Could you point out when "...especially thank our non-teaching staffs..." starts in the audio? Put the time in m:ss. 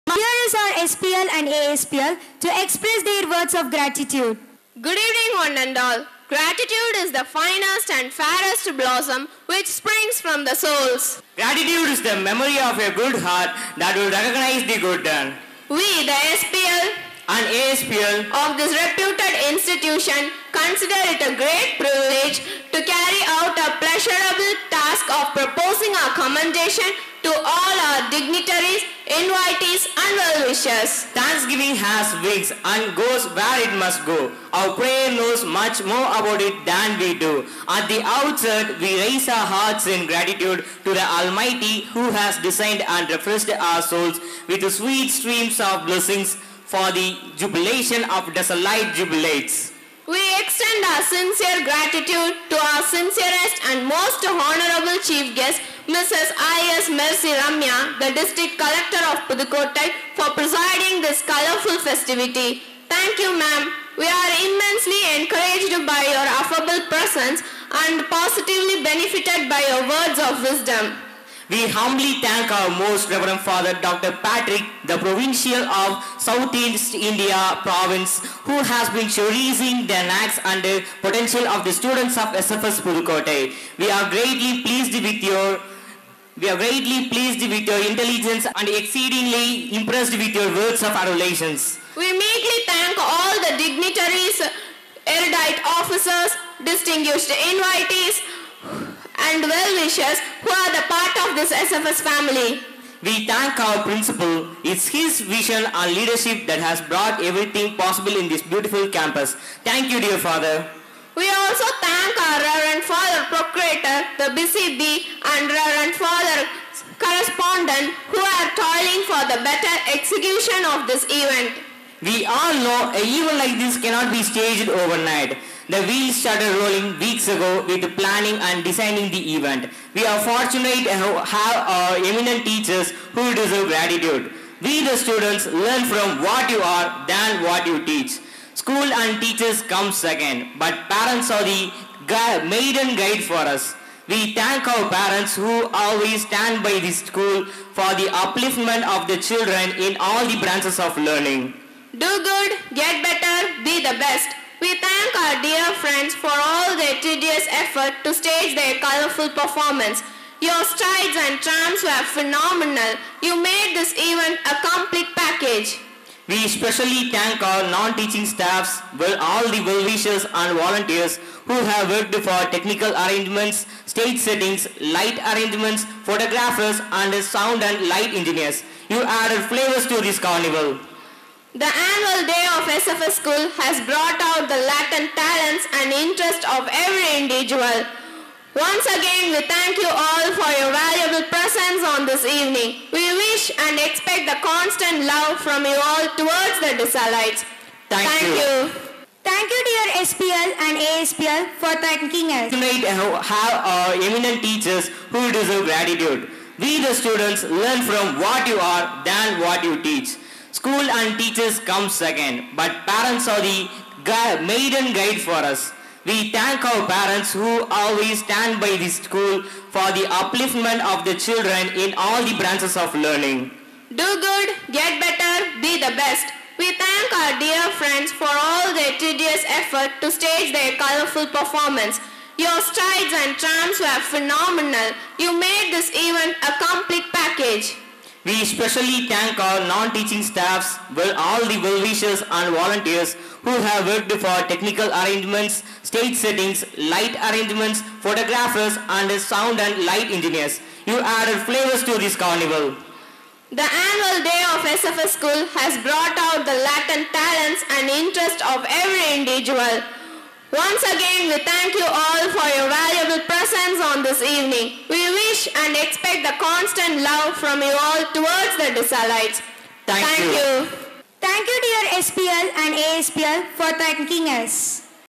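2:46.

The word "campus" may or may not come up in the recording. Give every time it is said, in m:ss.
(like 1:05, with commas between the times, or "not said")
1:48.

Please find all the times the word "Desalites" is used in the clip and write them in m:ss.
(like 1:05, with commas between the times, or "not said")
3:16, 4:28.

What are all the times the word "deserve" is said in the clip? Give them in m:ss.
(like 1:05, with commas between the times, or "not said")
2:13, 3:25.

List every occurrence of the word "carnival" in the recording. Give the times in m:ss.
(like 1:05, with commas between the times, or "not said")
3:00, 4:12.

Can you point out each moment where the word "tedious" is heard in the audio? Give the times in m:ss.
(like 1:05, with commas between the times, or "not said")
2:37, 3:48.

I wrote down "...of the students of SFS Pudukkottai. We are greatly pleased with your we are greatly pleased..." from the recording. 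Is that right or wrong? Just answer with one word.
right.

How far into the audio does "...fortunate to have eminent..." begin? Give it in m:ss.
2:10.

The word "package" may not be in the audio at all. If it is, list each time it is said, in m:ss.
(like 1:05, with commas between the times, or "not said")
2:45, 3:57.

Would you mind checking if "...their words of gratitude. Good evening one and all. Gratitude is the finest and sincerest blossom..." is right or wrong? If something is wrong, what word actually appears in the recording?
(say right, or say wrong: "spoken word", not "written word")
wrong: "fairest", not "sincerest".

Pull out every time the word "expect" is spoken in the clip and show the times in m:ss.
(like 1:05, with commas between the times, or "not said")
3:13, 4:25.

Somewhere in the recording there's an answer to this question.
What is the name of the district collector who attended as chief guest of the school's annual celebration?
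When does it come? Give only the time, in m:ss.
0:55.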